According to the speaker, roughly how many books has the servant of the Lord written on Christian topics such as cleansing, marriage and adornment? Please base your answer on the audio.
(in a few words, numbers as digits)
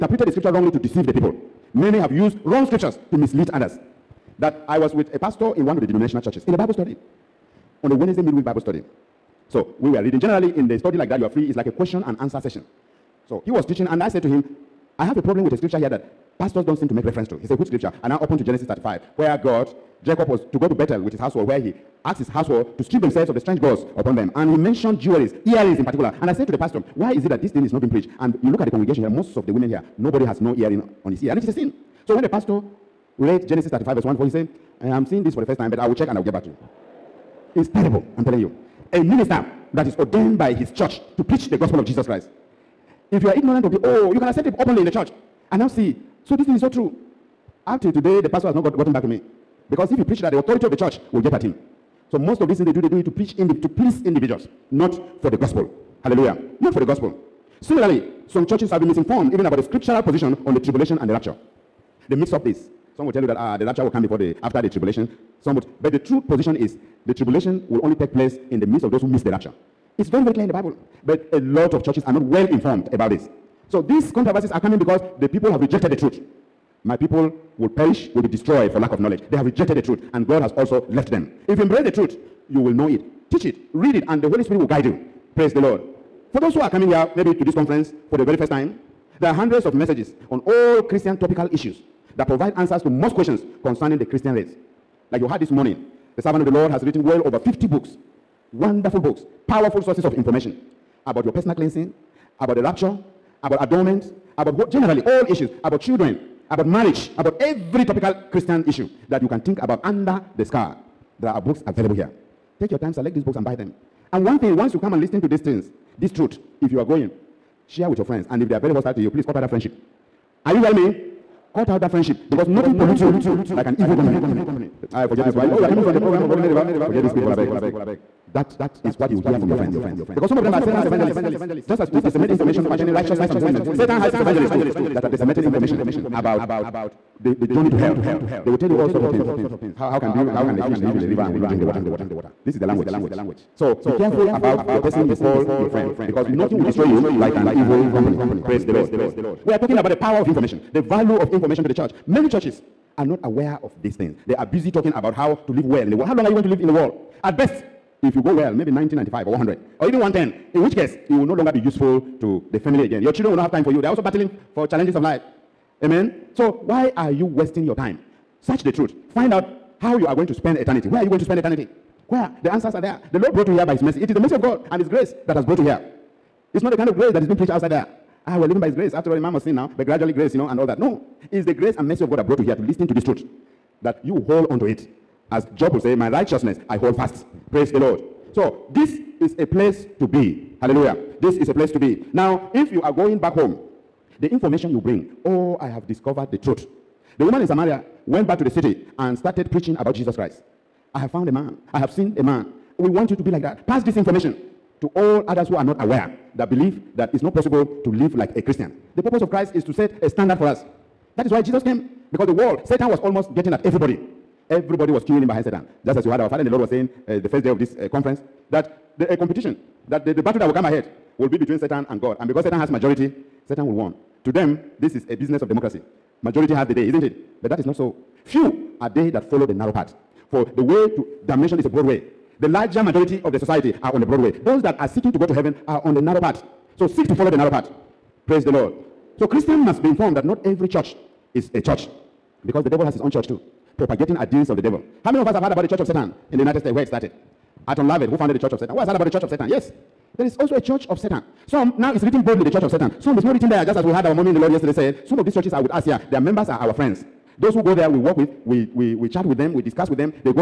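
Over 50.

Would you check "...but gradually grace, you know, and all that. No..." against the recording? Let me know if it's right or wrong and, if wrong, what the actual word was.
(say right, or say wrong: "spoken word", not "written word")
right.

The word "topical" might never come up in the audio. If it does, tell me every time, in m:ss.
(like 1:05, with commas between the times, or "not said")
1:31, 1:47.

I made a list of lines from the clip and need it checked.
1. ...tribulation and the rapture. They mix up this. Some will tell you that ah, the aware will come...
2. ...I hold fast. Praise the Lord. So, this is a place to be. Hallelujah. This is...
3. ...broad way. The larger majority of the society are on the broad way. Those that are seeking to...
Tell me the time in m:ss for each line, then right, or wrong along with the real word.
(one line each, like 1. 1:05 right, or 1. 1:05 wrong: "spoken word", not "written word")
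1. 1:00 wrong: "rapture", not "aware"
2. 3:06 right
3. 3:51 right.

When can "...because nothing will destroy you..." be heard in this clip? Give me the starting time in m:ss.
2:26.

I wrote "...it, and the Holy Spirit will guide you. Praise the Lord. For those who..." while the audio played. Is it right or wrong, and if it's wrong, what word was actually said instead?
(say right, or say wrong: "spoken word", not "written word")
right.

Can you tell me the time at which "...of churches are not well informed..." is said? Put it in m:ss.
1:11.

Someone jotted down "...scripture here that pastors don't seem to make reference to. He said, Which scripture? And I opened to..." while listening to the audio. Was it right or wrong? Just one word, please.
right.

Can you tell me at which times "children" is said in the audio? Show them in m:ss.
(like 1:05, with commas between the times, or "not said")
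1:45, 2:43.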